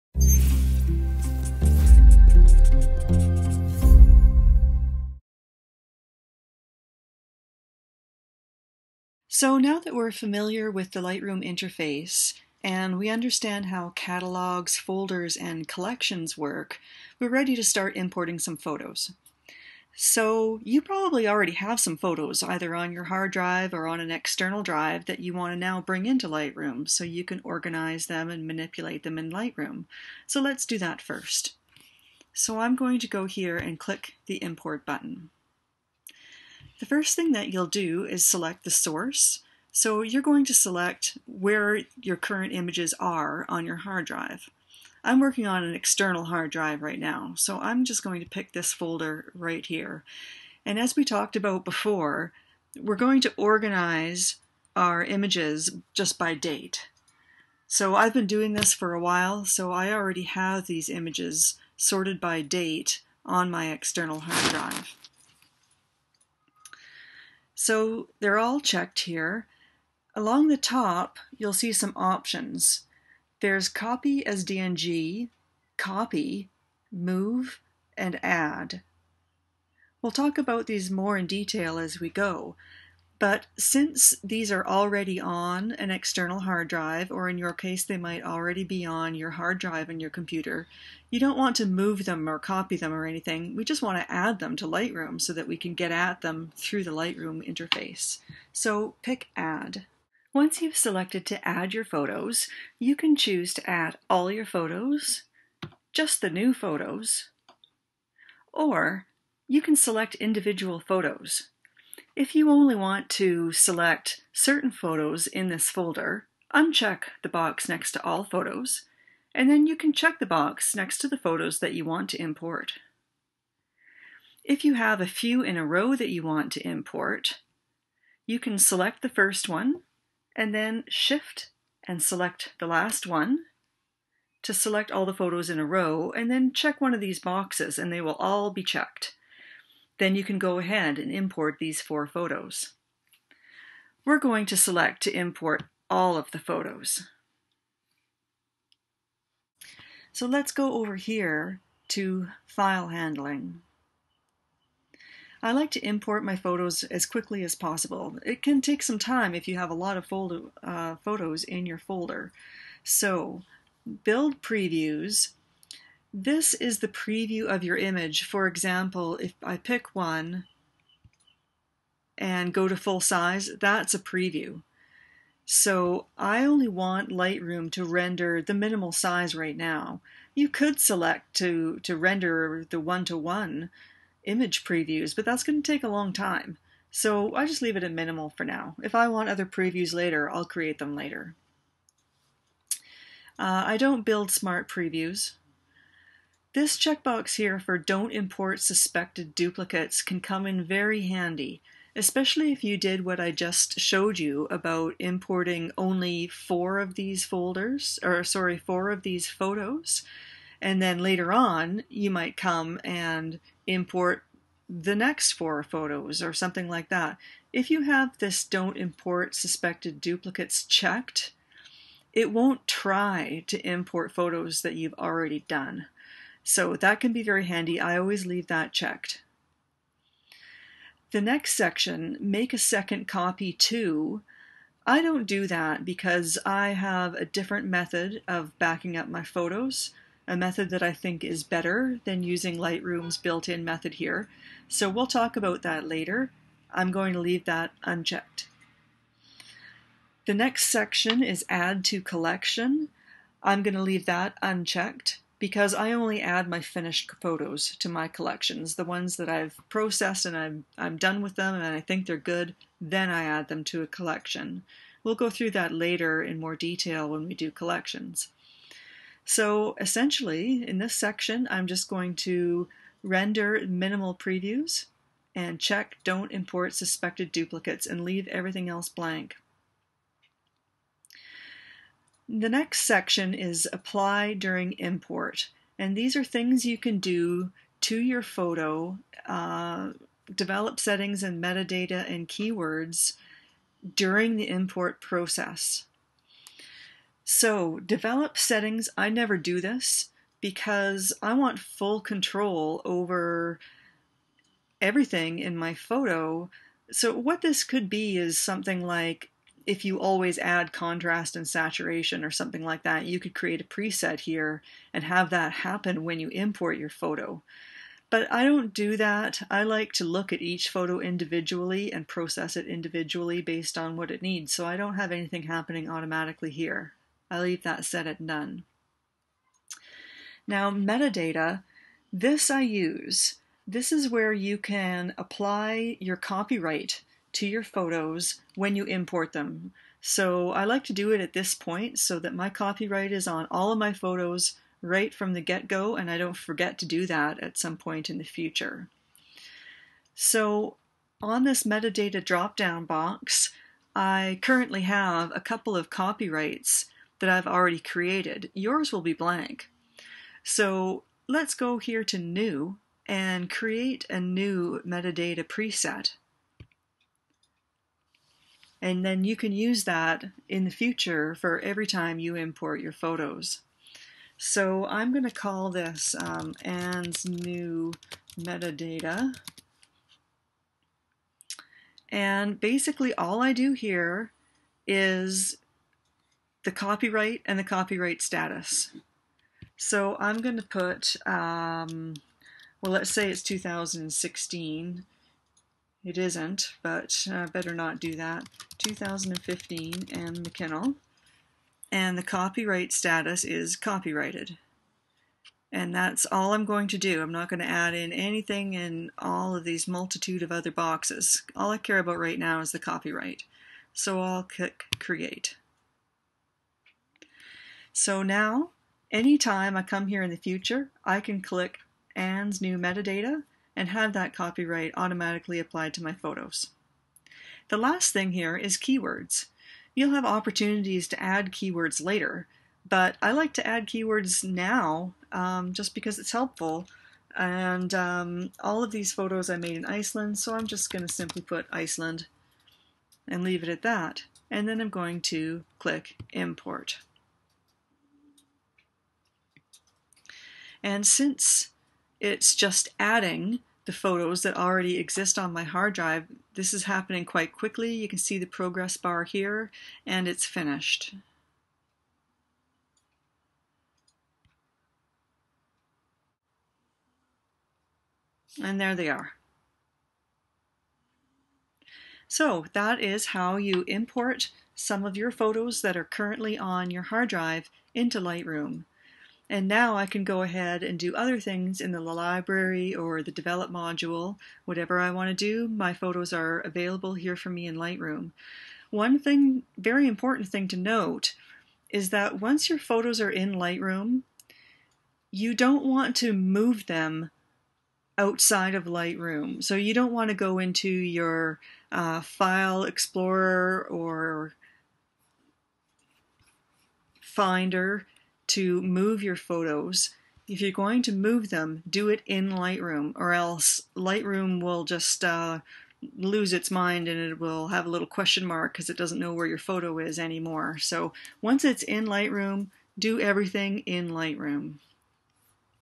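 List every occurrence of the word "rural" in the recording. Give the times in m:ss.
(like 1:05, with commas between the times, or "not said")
not said.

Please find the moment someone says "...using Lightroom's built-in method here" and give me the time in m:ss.
4:02.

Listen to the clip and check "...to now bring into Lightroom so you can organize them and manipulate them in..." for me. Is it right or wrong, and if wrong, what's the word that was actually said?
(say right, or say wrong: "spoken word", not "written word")
right.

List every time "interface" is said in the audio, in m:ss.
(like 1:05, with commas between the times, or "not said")
0:11, 1:37.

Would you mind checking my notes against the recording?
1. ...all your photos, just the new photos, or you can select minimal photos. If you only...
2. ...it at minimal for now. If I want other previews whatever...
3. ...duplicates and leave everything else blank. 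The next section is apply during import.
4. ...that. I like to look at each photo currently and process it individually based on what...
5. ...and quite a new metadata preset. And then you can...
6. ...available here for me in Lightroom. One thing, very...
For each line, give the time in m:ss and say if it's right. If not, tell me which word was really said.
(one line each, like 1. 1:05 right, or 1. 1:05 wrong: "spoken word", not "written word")
1. 1:44 wrong: "individual", not "minimal"
2. 3:07 wrong: "later", not "whatever"
3. 4:37 right
4. 5:18 wrong: "individually", not "currently"
5. 6:03 wrong: "create", not "quite"
6. 8:06 right.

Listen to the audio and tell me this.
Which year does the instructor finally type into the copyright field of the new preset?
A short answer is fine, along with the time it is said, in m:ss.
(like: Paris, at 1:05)
2015, at 6:38.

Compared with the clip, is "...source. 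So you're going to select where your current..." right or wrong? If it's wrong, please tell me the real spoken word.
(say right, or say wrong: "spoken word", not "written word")
right.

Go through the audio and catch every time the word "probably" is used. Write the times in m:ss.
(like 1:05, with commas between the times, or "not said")
0:20.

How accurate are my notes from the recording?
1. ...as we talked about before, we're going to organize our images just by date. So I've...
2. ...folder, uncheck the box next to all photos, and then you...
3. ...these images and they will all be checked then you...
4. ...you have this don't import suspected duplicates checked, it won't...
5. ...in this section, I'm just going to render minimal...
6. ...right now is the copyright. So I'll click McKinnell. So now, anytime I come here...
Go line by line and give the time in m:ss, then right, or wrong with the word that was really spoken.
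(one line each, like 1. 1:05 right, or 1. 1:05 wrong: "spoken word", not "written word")
1. 0:50 right
2. 1:55 right
3. 2:16 wrong: "boxes", not "images"
4. 3:37 right
5. 4:30 right
6. 6:52 wrong: "Create", not "McKinnell".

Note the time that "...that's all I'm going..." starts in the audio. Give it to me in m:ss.
6:45.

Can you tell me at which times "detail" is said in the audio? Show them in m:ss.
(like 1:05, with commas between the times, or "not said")
1:21, 4:26.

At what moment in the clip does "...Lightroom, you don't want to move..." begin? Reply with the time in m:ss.
8:13.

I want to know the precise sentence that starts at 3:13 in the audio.
Uh, I don't build smart previews.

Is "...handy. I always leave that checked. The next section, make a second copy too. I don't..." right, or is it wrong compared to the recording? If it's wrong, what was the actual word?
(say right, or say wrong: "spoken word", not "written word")
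right.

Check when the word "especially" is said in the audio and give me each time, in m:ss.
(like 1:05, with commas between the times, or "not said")
3:21.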